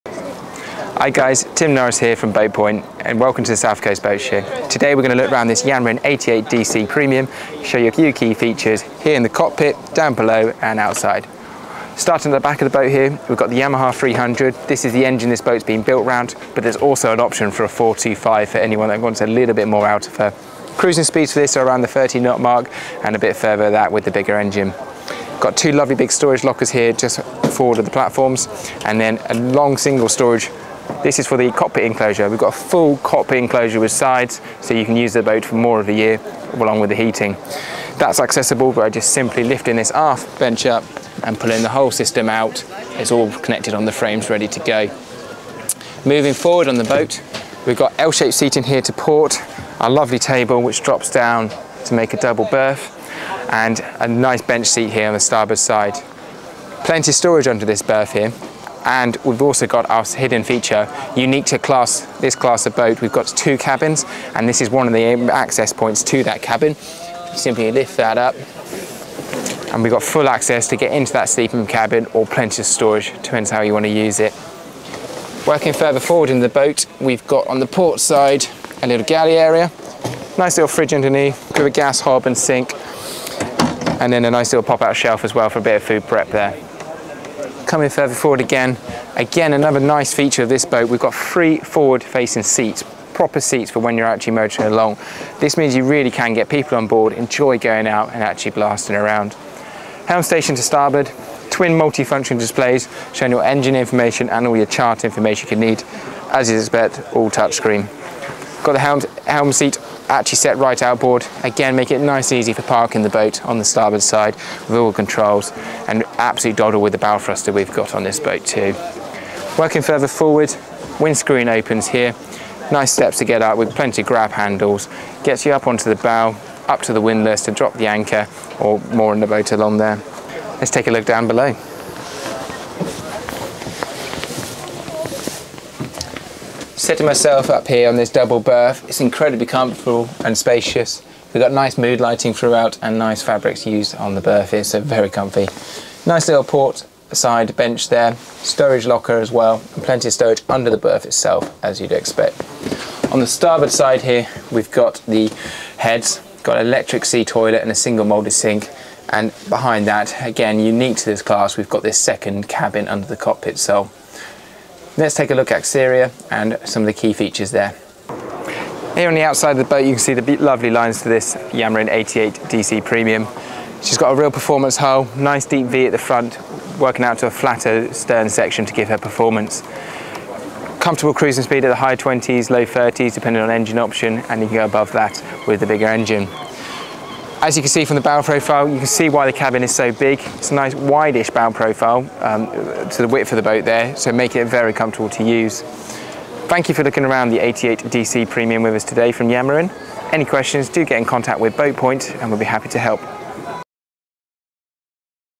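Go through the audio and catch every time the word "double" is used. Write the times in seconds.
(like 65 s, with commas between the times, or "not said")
52 s, 138 s.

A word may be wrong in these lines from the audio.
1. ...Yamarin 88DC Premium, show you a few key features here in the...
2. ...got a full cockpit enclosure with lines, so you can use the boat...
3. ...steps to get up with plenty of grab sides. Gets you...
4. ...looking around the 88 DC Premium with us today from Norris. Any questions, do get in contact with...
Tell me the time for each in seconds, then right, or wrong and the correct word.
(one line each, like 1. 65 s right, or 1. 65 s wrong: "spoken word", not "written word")
1. 5 s right
2. 32 s wrong: "sides", not "lines"
3. 122 s wrong: "handles", not "sides"
4. 196 s wrong: "Yamarin", not "Norris".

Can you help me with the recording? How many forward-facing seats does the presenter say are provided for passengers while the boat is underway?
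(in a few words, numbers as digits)
3.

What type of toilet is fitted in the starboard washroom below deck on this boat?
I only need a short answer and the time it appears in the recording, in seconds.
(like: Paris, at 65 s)
electric sea toilet, at 156 s.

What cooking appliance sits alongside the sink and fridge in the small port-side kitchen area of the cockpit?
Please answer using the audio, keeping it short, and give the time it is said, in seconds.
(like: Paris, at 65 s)
gas hob, at 81 s.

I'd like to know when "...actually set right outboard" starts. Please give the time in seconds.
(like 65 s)
110 s.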